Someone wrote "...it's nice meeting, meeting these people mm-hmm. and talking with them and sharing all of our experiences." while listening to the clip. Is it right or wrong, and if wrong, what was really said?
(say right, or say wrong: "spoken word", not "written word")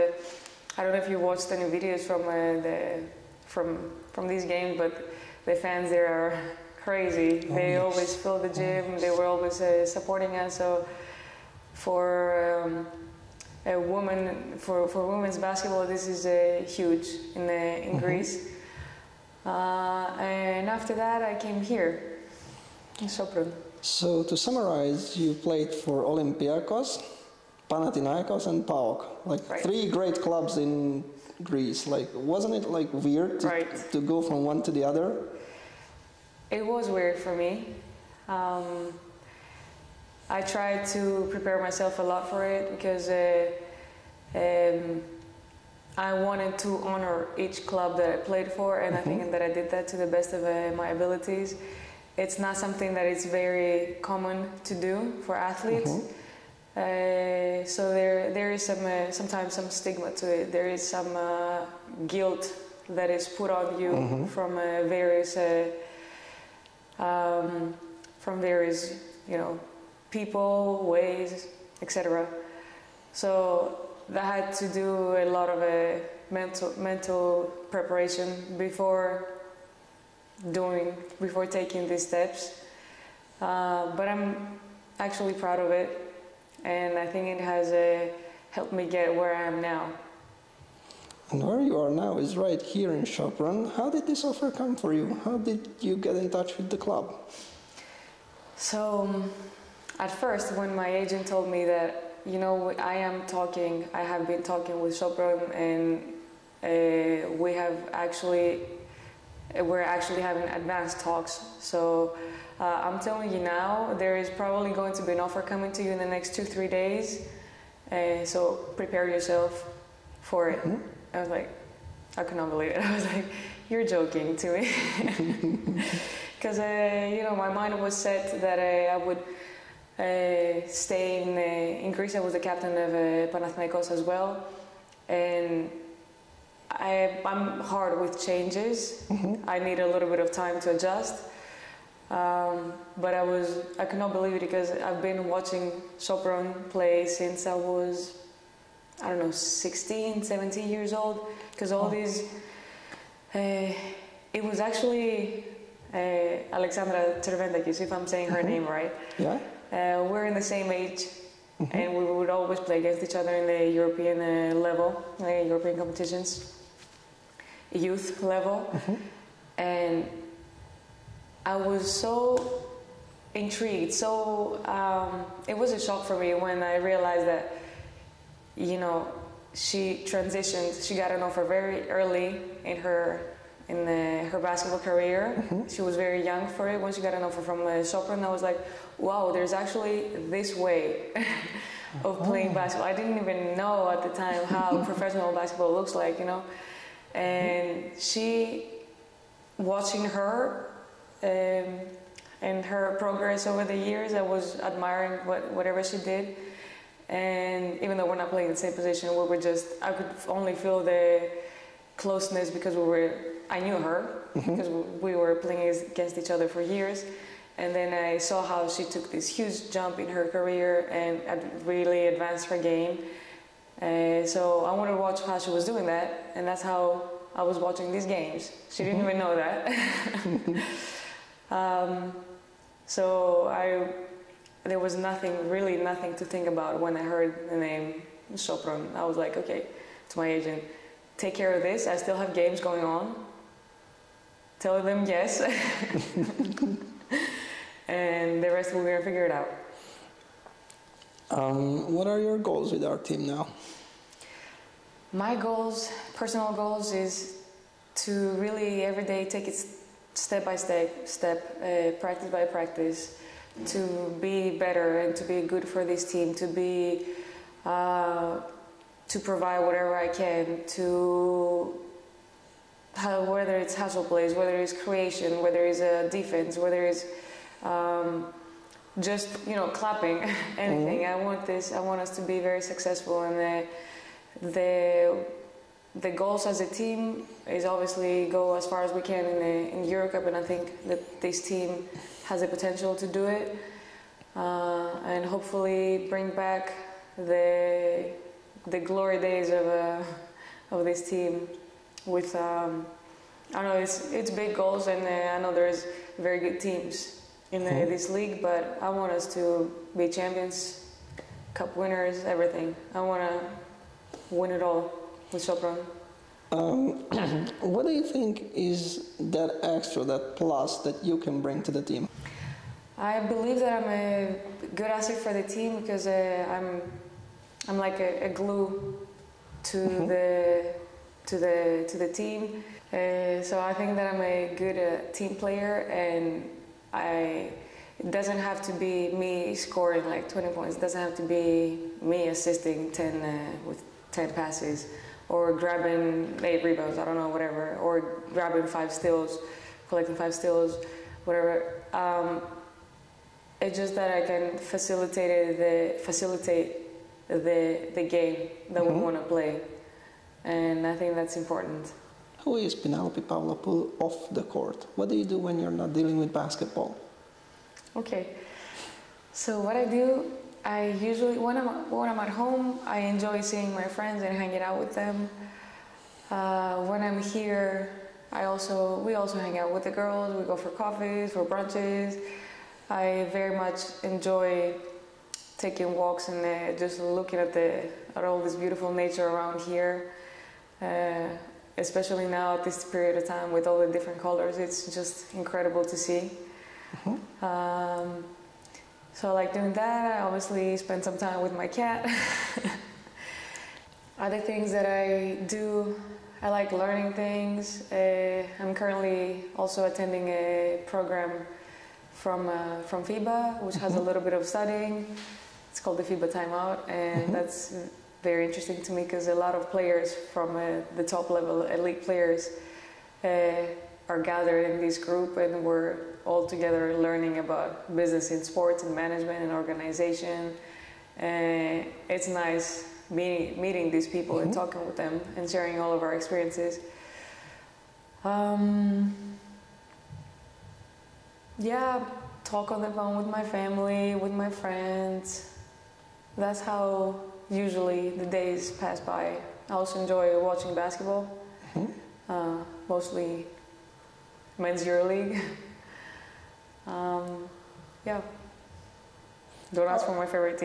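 right.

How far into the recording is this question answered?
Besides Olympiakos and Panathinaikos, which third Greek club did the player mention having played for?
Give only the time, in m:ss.
0:28.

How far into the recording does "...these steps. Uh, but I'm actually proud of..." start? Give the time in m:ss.
1:21.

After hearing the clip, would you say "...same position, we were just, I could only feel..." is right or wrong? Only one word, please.
right.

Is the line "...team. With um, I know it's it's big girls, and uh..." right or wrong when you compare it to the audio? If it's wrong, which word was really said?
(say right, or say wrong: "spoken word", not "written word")
wrong: "goals", not "girls".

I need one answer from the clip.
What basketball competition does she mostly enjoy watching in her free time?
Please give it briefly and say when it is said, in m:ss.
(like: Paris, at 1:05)
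Men's EuroLeague, at 7:34.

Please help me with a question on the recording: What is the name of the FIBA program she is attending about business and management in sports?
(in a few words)
FIBA Timeout.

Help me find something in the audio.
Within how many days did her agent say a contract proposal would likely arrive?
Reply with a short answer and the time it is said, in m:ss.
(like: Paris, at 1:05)
2 or 3 days, at 1:56.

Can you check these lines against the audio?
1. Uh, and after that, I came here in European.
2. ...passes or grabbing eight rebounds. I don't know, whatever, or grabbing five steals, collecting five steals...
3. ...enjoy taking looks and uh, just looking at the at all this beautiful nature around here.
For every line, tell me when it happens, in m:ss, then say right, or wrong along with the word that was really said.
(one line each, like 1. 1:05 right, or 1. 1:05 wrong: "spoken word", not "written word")
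1. 0:19 wrong: "Sopron", not "European"
2. 5:44 right
3. 6:24 wrong: "walks", not "looks".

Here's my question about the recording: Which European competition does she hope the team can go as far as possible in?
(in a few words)
Eurocup.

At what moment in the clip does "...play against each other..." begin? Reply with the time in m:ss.
2:42.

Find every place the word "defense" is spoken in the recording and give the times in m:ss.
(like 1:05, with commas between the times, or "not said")
4:36.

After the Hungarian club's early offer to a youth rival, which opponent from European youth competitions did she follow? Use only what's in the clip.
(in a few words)
Alexandra Cerventakis.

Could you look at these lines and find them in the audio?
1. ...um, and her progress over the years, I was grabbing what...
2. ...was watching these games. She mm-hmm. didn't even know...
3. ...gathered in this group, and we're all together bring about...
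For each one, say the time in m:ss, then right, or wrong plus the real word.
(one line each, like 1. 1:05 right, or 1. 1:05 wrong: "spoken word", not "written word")
1. 3:21 wrong: "admiring", not "grabbing"
2. 3:47 right
3. 7:04 wrong: "learning", not "bring".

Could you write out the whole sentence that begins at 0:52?
It's not something that is very common to do for athletes.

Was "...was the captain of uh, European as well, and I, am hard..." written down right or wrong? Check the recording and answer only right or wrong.
wrong.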